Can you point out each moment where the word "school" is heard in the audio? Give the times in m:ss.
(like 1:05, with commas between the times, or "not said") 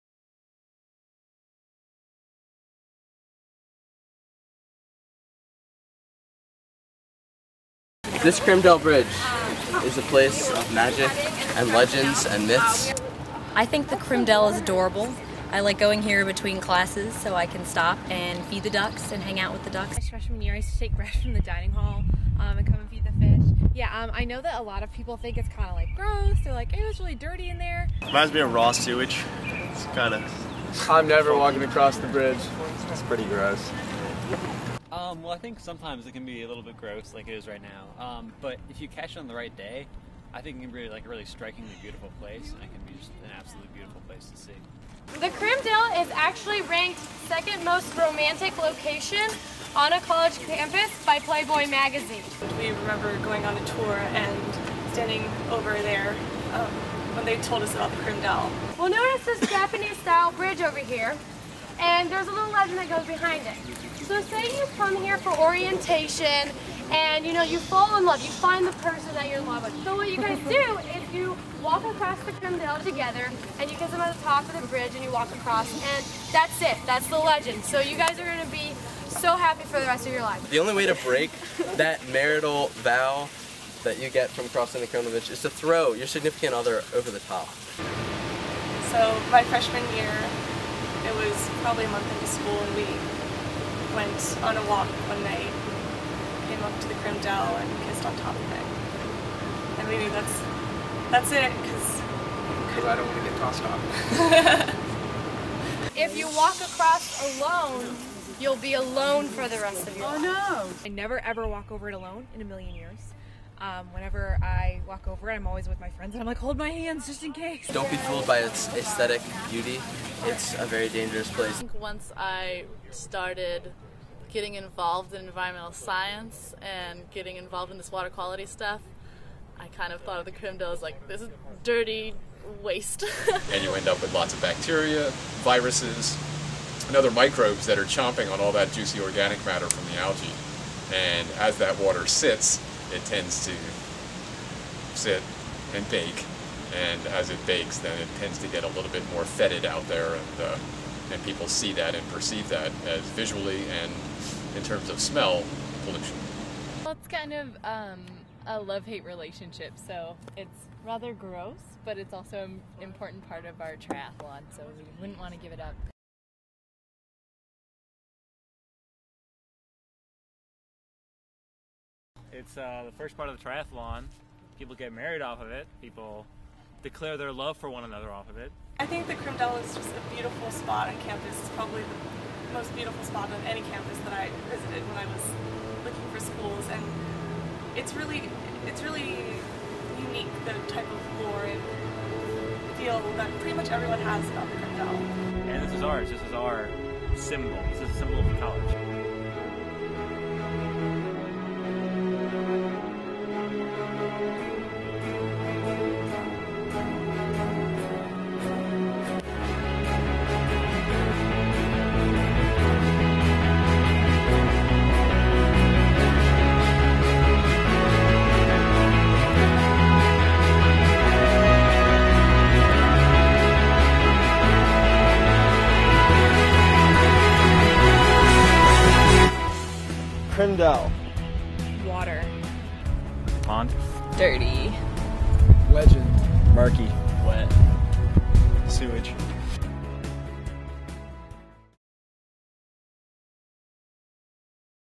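1:32, 3:06.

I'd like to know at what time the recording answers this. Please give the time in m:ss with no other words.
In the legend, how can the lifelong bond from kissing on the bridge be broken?
1:25.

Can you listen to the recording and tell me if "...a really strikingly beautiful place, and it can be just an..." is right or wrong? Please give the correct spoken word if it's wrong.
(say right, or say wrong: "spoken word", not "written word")
right.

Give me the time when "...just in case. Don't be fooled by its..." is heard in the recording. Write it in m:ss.
1:57.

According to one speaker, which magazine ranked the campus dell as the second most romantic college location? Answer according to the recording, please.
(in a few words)
Playboy.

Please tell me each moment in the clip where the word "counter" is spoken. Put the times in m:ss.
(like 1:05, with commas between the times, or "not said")
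not said.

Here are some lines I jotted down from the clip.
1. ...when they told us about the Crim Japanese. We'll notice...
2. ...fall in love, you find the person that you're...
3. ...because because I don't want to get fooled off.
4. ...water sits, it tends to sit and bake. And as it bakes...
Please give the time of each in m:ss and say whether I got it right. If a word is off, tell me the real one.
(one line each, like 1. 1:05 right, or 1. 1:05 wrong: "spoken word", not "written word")
1. 0:57 wrong: "Dell", not "Japanese"
2. 1:07 right
3. 1:41 wrong: "tossed", not "fooled"
4. 2:21 right.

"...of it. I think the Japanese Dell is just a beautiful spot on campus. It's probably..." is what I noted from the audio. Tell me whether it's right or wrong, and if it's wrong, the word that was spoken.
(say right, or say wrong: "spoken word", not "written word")
wrong: "Crim", not "Japanese".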